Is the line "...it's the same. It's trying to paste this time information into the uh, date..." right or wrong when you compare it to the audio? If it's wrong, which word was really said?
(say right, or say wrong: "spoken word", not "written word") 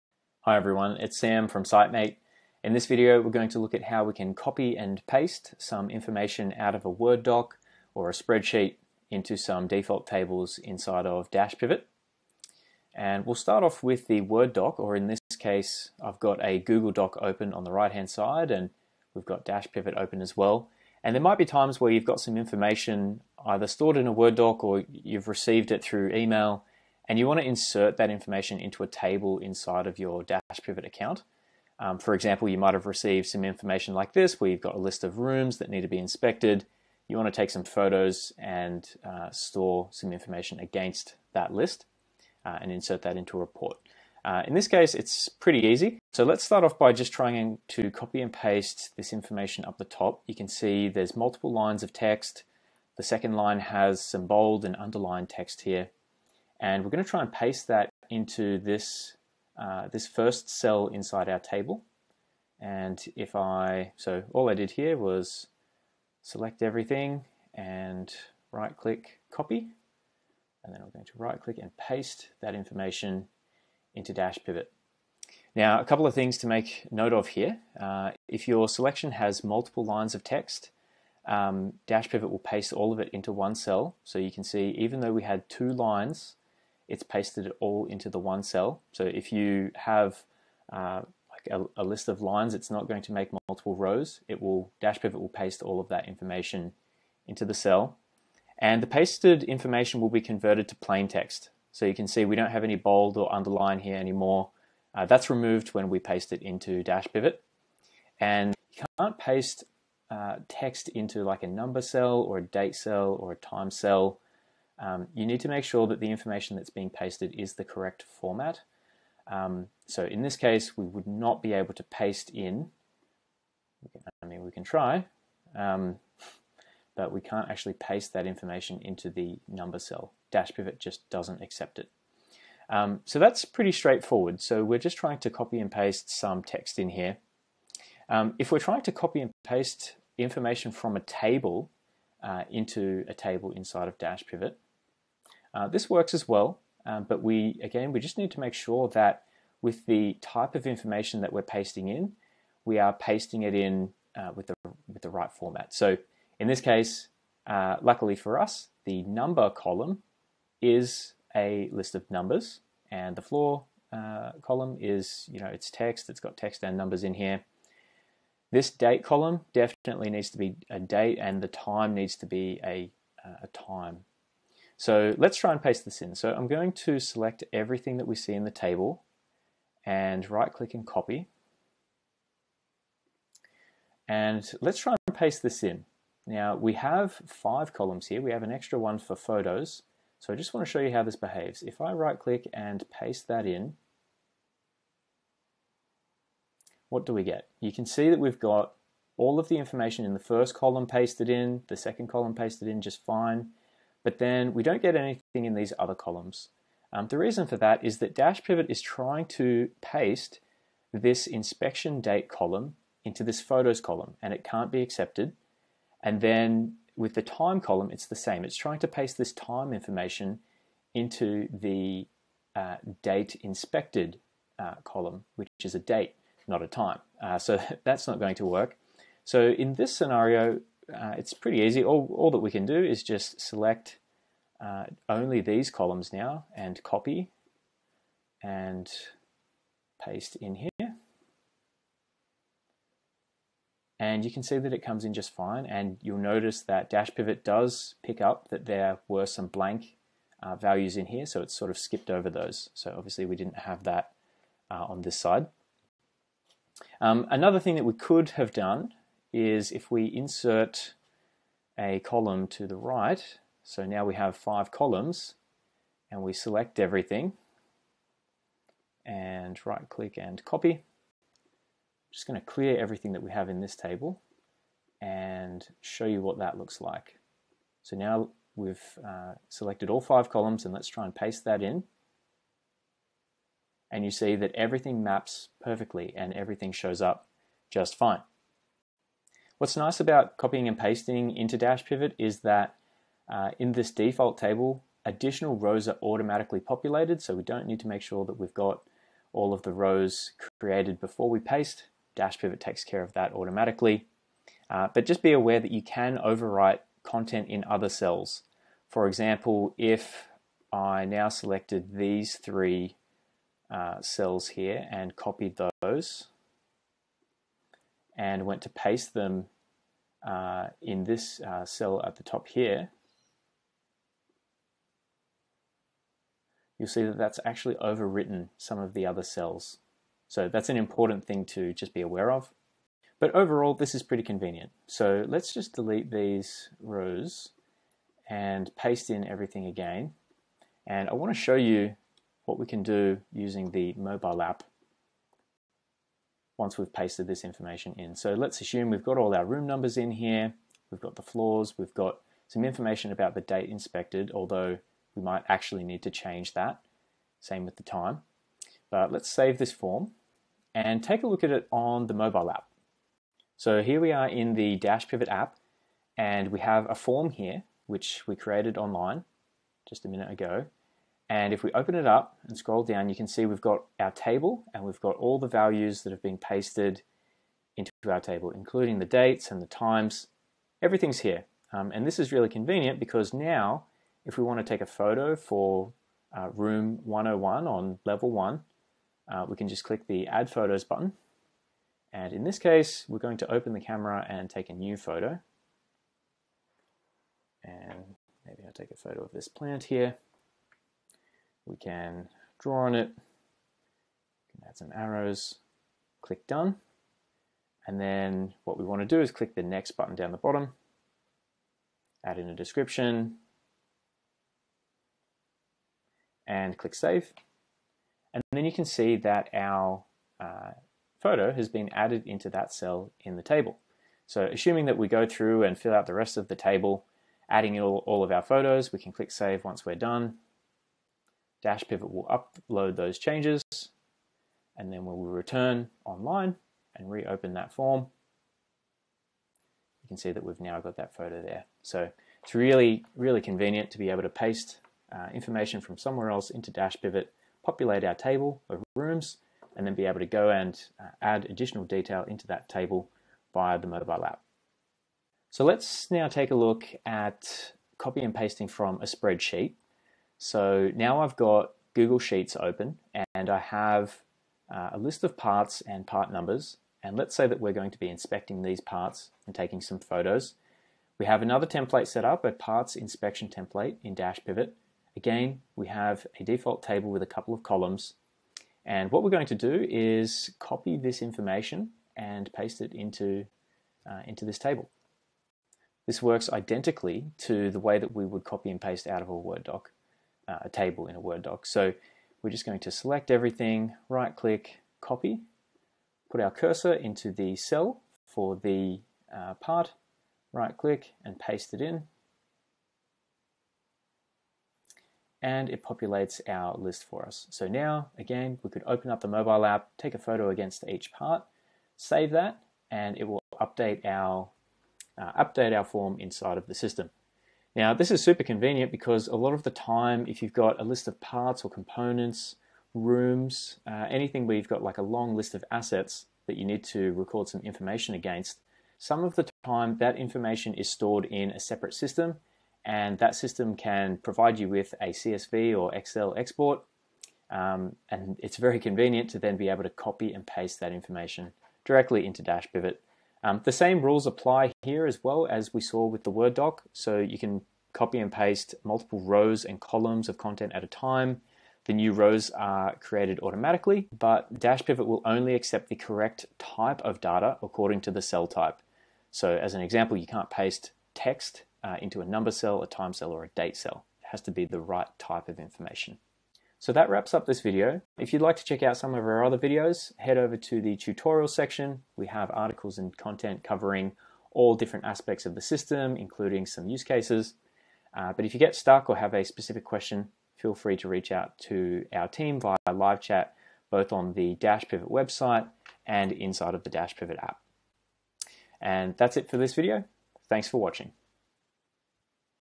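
right.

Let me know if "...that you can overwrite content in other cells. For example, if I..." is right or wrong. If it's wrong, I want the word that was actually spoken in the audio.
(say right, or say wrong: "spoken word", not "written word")
right.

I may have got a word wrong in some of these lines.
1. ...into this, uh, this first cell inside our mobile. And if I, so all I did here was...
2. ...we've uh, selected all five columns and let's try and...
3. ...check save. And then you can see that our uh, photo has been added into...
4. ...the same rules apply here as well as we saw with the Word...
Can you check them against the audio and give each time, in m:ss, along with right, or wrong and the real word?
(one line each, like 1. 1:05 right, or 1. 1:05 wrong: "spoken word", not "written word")
1. 0:58 wrong: "table", not "mobile"
2. 4:38 right
3. 6:56 wrong: "click", not "check"
4. 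9:03 right.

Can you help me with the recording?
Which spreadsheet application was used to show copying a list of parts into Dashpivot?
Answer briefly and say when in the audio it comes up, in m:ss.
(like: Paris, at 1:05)
Google Sheets, at 7:41.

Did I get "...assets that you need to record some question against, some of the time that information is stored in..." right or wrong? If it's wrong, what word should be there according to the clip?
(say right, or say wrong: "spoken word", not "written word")
wrong: "information", not "question".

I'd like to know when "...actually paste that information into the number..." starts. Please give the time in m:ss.
2:07.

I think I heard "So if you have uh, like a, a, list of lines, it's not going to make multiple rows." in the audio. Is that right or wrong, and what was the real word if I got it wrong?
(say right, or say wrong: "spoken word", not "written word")
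right.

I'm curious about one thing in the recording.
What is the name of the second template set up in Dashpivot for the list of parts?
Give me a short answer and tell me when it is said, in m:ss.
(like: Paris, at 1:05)
parts inspection template, at 7:52.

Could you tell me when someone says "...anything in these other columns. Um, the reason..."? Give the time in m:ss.
3:24.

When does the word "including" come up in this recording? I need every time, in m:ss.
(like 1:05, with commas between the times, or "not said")
6:18, 9:36.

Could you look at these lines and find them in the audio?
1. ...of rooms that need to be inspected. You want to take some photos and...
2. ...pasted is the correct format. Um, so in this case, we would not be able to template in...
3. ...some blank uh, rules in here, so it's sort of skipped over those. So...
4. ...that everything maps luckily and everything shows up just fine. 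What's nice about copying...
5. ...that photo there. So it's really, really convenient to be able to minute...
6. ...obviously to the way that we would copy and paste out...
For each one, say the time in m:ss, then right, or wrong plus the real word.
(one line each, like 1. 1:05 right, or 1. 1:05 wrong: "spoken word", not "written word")
1. 0:35 right
2. 1:56 wrong: "paste", not "template"
3. 4:09 wrong: "values", not "rules"
4. 4:44 wrong: "perfectly", not "luckily"
5. 7:20 wrong: "paste", not "minute"
6. 8:06 wrong: "identically", not "obviously".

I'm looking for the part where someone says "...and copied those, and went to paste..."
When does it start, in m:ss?
5:14.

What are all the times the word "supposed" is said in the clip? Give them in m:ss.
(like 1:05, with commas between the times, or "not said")
not said.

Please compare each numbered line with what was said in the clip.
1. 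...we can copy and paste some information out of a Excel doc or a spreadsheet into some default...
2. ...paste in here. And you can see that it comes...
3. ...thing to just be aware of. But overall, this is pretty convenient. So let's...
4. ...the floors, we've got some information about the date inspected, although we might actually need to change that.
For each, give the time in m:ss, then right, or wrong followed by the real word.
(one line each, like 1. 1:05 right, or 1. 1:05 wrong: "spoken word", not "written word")
1. 0:04 wrong: "Word", not "Excel"
2. 4:00 right
3. 5:31 right
4. 5:51 right.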